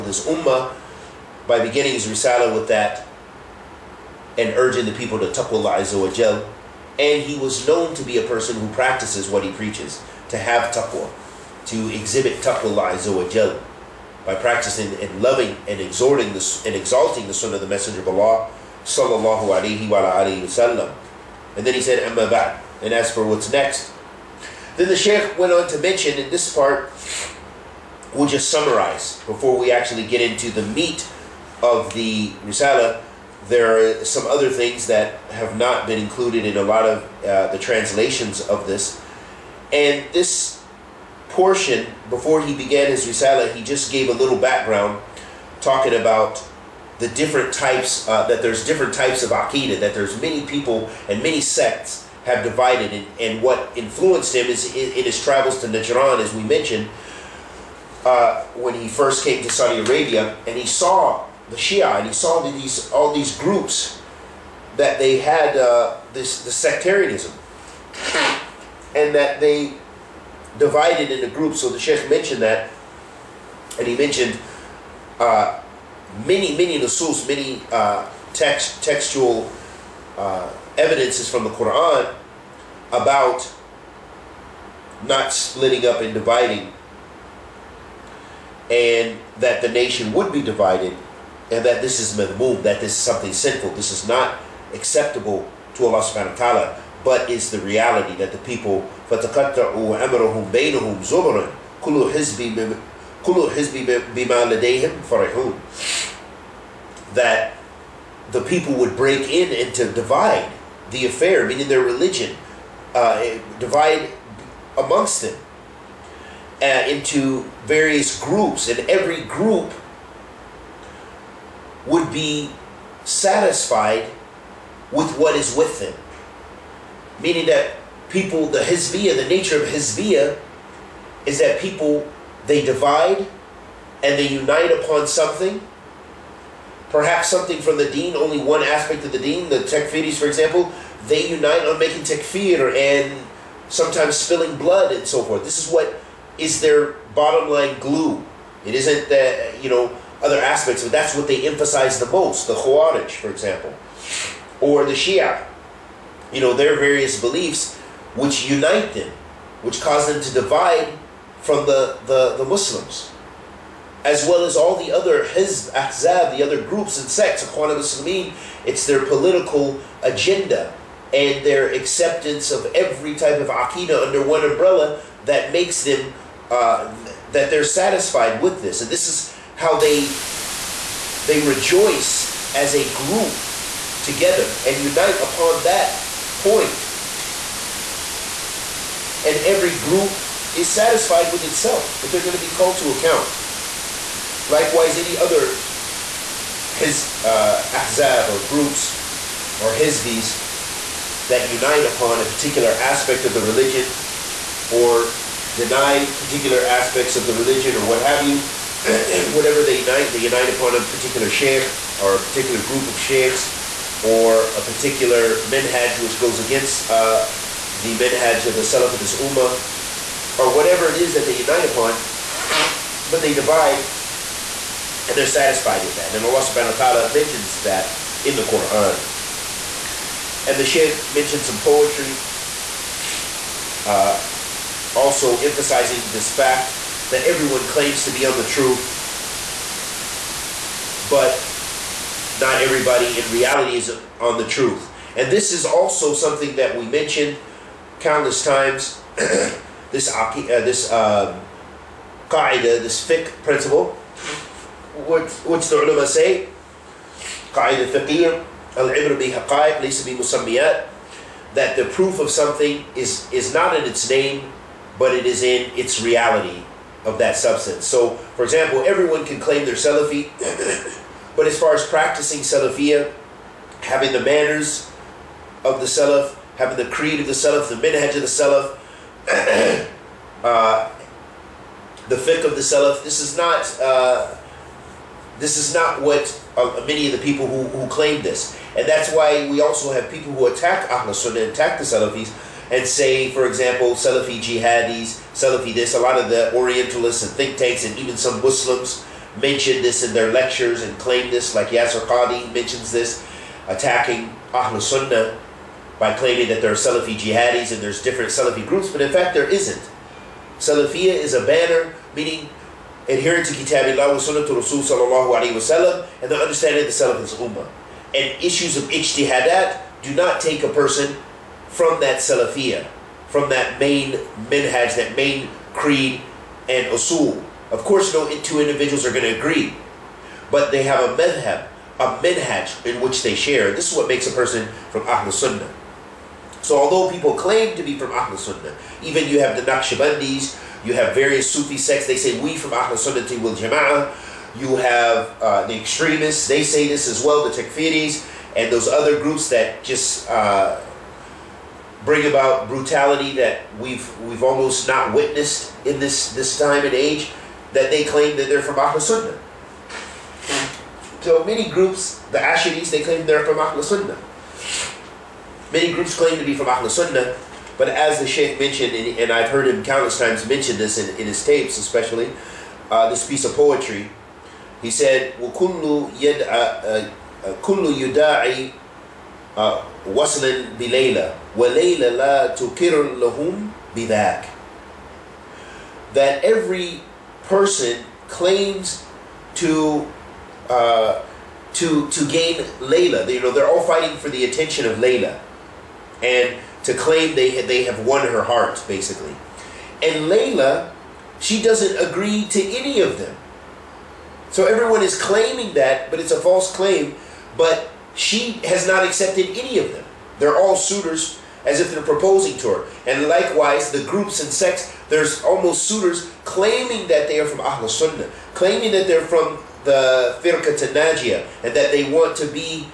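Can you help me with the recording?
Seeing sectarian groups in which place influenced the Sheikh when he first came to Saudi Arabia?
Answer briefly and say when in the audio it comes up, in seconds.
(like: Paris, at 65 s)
Najran, at 55 s.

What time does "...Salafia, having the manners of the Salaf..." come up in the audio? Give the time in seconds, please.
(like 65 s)
272 s.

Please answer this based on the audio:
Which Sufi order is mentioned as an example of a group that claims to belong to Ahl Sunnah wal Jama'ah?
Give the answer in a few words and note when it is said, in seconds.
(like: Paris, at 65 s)
Naqshbandis, at 339 s.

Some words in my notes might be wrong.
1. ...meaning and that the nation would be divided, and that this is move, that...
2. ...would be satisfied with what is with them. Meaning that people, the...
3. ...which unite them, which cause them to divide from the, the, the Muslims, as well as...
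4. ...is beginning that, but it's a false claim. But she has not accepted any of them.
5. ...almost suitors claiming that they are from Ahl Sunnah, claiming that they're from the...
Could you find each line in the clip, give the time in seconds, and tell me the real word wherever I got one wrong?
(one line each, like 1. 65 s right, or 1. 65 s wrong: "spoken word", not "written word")
1. 86 s wrong: "dividing", not "meaning"
2. 121 s right
3. 158 s right
4. 405 s wrong: "claiming", not "beginning"
5. 415 s right.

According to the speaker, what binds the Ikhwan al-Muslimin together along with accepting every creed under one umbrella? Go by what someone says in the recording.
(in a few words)
Their political agenda.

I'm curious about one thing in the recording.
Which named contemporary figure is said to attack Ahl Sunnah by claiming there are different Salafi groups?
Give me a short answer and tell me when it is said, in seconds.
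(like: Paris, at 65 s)
Yasir Qadhi, at 301 s.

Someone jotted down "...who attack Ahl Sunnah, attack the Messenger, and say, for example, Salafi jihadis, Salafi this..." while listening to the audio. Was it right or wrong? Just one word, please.
wrong.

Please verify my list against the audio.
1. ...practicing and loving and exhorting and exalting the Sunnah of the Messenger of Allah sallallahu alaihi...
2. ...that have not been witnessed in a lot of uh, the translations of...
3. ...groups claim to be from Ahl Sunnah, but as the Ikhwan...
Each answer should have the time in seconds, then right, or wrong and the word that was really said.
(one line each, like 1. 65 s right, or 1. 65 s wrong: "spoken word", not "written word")
1. 14 s right
2. 34 s wrong: "included", not "witnessed"
3. 365 s wrong: "Sheikh", not "Ikhwan".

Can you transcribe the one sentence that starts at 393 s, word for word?
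They, you know, they're all fighting for the attention of Layla, and to claim they they have won her heart, basically.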